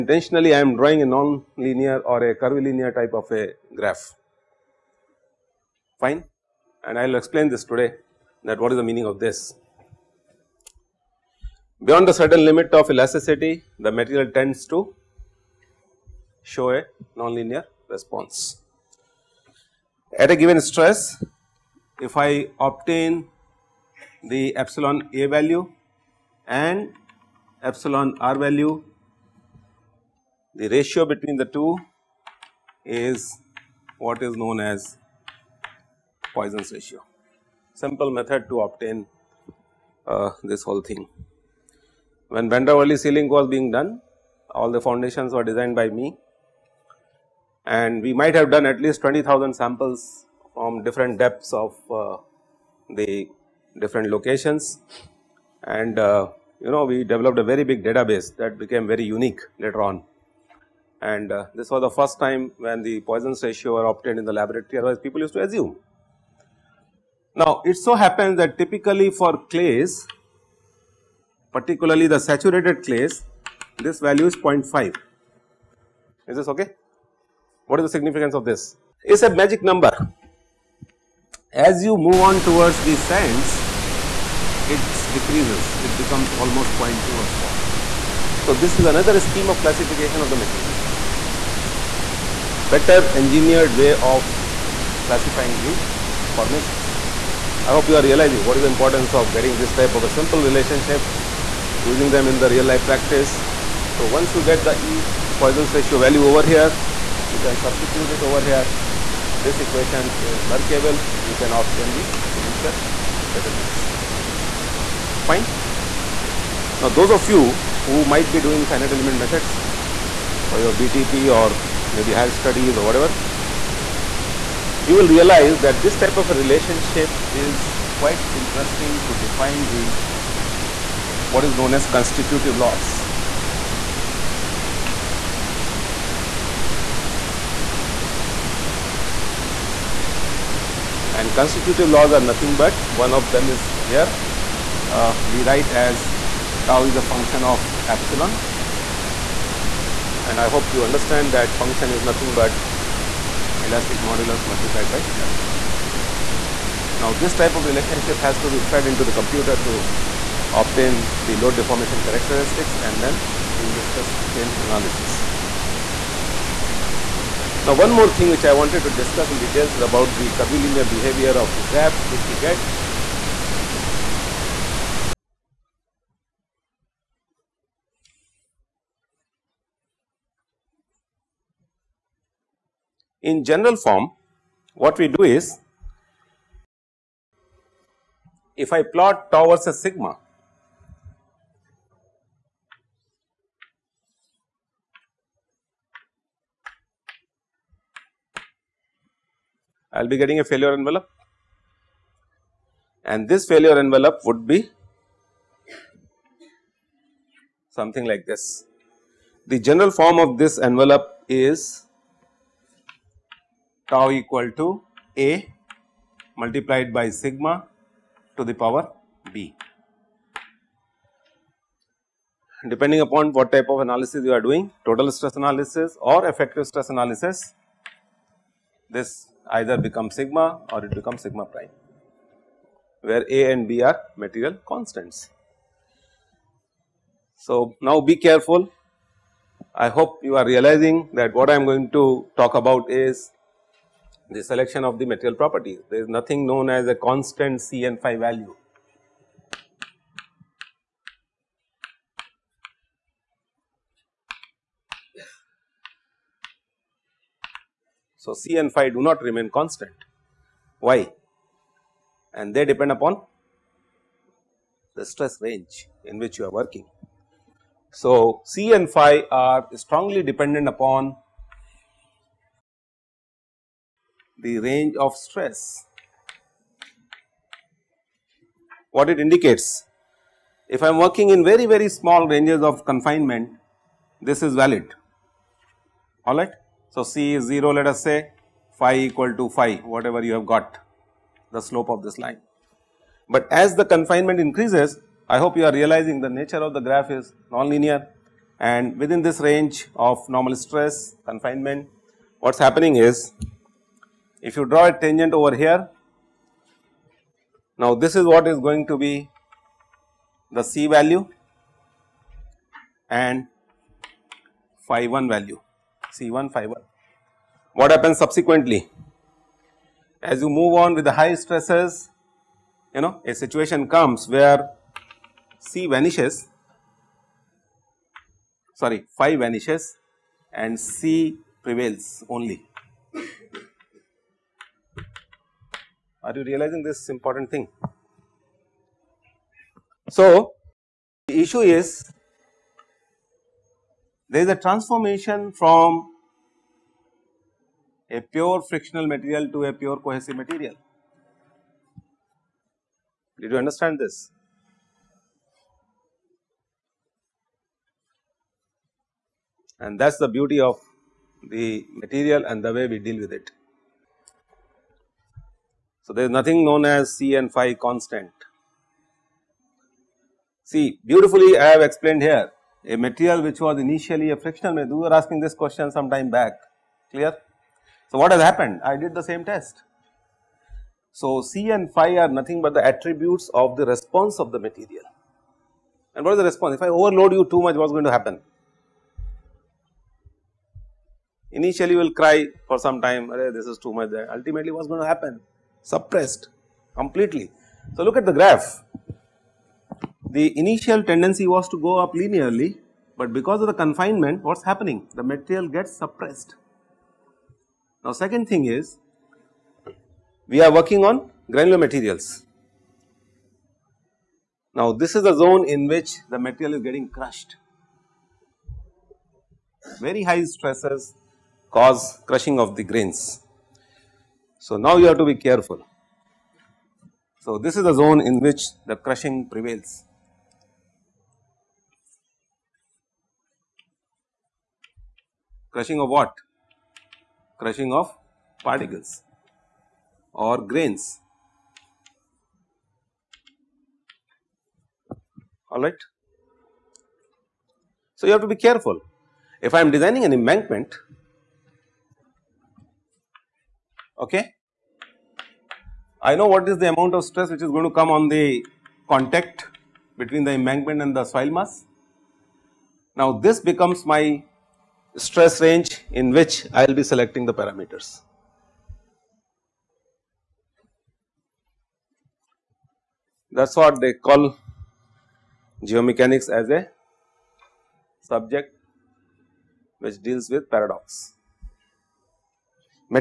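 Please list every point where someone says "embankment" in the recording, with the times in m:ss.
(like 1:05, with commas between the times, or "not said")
7:30, 7:40.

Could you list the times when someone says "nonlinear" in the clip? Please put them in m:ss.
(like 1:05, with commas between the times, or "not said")
0:17, 4:57.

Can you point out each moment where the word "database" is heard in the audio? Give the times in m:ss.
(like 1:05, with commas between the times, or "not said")
0:57.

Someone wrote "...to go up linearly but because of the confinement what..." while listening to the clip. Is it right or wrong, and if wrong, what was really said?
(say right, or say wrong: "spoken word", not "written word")
right.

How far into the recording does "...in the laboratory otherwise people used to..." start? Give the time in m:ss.
1:04.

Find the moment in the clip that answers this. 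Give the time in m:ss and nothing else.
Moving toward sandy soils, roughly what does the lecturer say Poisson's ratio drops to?
1:26.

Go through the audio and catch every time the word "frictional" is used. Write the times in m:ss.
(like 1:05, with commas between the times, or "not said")
5:48, 6:14.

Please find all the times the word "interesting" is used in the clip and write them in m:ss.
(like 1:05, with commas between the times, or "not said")
2:08.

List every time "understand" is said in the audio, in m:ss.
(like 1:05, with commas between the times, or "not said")
2:30, 5:53.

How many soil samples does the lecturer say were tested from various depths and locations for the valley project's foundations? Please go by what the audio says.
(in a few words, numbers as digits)
20,000.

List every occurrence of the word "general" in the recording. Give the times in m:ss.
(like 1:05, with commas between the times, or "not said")
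3:03, 3:29.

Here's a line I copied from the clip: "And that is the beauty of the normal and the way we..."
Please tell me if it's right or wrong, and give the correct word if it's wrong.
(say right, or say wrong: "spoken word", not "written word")
wrong: "material", not "normal".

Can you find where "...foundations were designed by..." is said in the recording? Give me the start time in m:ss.
0:44.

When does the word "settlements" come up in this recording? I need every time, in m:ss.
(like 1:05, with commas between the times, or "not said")
1:53.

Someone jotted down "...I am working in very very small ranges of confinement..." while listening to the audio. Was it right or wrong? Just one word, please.
right.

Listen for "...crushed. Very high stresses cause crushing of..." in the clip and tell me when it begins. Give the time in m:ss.
6:57.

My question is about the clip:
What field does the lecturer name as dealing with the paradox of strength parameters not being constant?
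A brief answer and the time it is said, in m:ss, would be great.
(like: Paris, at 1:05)
geomechanics, at 7:55.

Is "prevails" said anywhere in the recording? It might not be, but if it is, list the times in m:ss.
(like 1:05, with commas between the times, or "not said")
5:31, 7:09.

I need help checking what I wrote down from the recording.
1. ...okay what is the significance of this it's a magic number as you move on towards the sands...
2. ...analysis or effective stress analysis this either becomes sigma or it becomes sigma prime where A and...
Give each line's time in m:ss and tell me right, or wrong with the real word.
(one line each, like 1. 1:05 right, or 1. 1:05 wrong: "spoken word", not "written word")
1. 1:16 right
2. 3:45 right.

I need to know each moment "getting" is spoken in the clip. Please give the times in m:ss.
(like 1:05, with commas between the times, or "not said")
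1:39, 3:20, 6:56.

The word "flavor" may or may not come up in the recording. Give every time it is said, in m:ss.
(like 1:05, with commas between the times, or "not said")
not said.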